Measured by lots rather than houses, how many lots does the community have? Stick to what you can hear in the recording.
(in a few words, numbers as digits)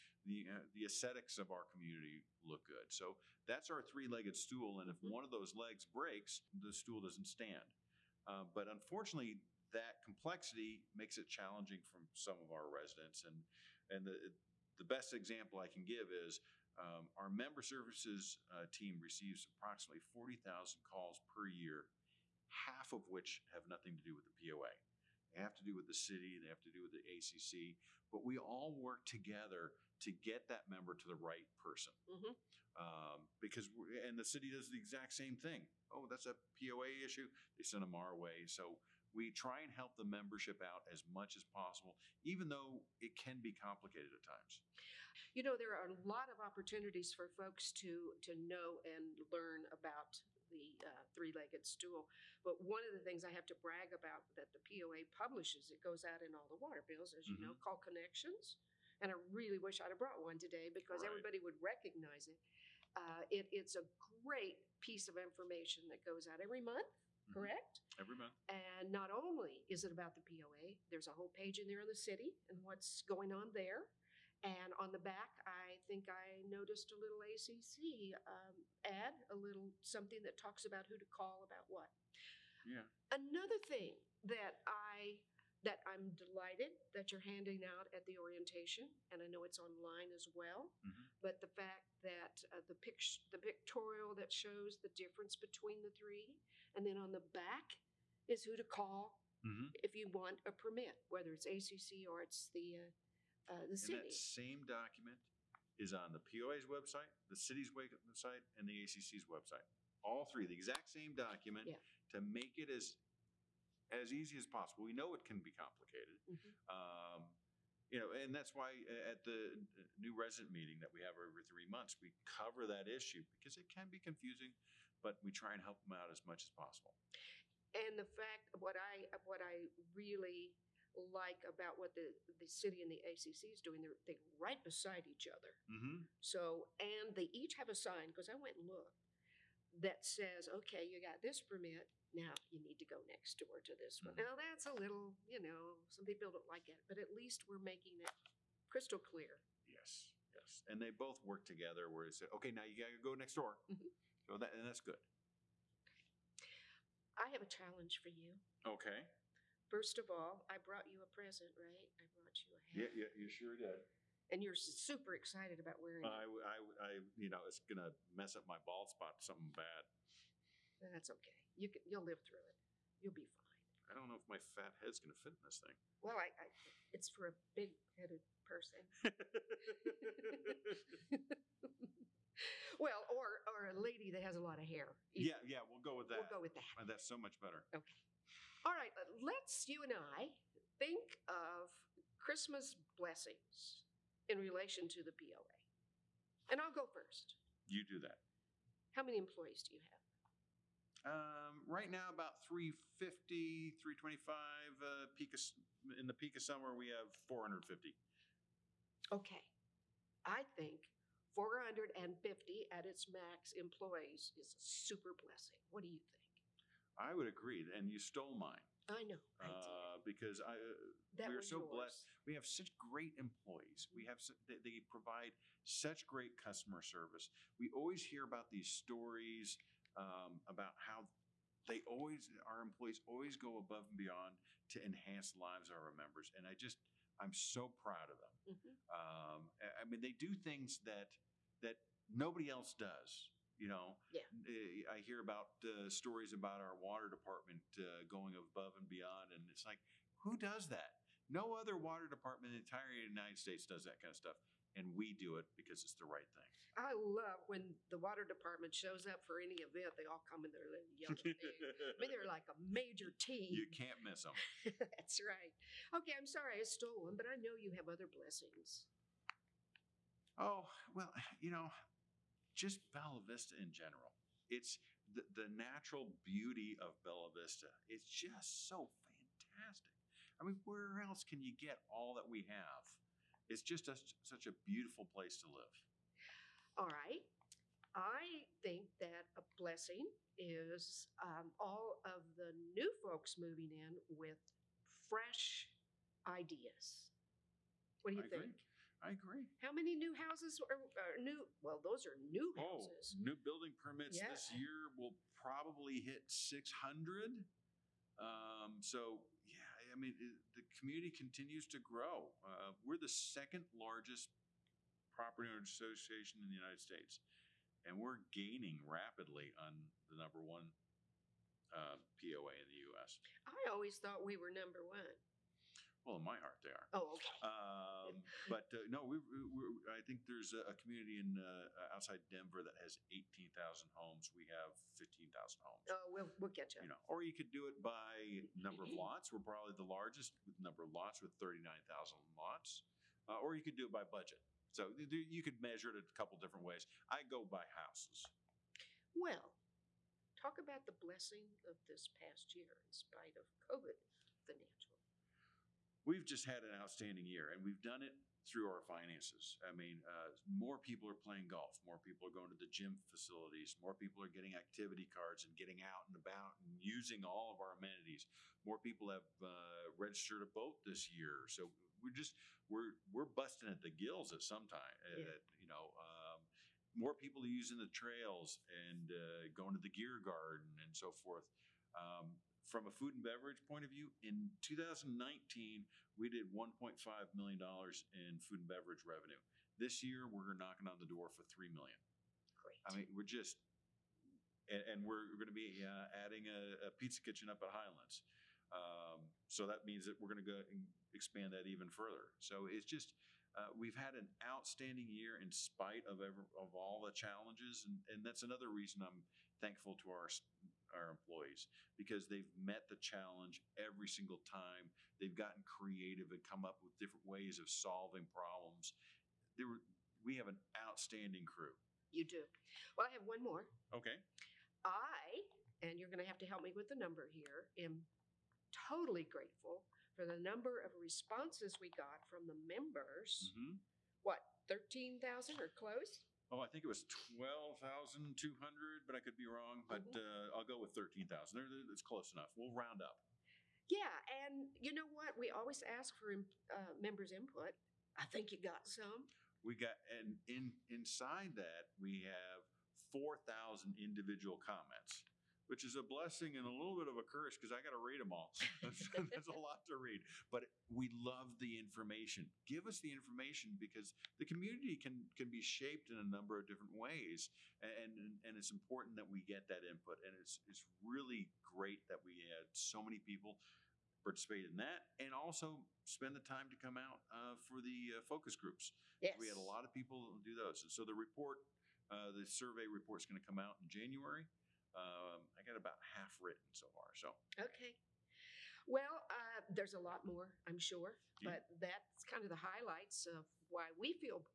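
39,000.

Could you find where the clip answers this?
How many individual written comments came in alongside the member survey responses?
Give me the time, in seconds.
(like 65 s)
453 s.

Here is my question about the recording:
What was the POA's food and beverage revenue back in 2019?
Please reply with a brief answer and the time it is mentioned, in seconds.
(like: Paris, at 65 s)
$1.5 million, at 386 s.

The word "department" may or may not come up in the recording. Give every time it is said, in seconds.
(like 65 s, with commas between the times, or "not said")
247 s, 252 s, 258 s.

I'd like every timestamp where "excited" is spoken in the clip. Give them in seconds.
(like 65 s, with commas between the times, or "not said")
165 s.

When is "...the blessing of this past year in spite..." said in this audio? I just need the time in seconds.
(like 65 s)
350 s.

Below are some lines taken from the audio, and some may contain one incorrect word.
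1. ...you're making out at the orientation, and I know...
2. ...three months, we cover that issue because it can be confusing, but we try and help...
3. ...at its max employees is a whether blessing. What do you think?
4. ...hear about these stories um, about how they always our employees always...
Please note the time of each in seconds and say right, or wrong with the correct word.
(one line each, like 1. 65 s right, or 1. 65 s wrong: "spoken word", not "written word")
1. 87 s wrong: "handing", not "making"
2. 121 s right
3. 212 s wrong: "super", not "whether"
4. 228 s right.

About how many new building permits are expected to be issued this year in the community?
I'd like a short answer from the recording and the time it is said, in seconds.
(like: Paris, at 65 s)
600, at 306 s.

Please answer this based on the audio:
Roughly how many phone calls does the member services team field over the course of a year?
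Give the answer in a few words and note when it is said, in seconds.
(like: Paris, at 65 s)
40,000, at 20 s.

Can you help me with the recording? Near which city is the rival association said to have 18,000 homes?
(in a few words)
Denver.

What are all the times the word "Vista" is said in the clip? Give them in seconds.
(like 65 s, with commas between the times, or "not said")
273 s, 277 s.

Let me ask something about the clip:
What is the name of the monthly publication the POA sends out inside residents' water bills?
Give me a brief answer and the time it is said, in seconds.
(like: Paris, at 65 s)
Connections, at 57 s.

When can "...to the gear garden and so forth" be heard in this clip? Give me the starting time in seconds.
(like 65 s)
379 s.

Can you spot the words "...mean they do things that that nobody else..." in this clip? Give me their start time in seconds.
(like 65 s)
239 s.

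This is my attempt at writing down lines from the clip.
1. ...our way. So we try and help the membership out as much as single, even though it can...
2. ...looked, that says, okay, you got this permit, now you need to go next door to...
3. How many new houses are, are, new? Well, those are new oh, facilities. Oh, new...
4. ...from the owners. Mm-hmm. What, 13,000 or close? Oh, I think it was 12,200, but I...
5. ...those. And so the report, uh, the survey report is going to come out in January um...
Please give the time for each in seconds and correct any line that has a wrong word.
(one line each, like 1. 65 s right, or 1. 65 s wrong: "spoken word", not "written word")
1. 37 s wrong: "possible", not "single"
2. 138 s right
3. 299 s wrong: "houses", not "facilities"
4. 432 s wrong: "members", not "owners"
5. 480 s right.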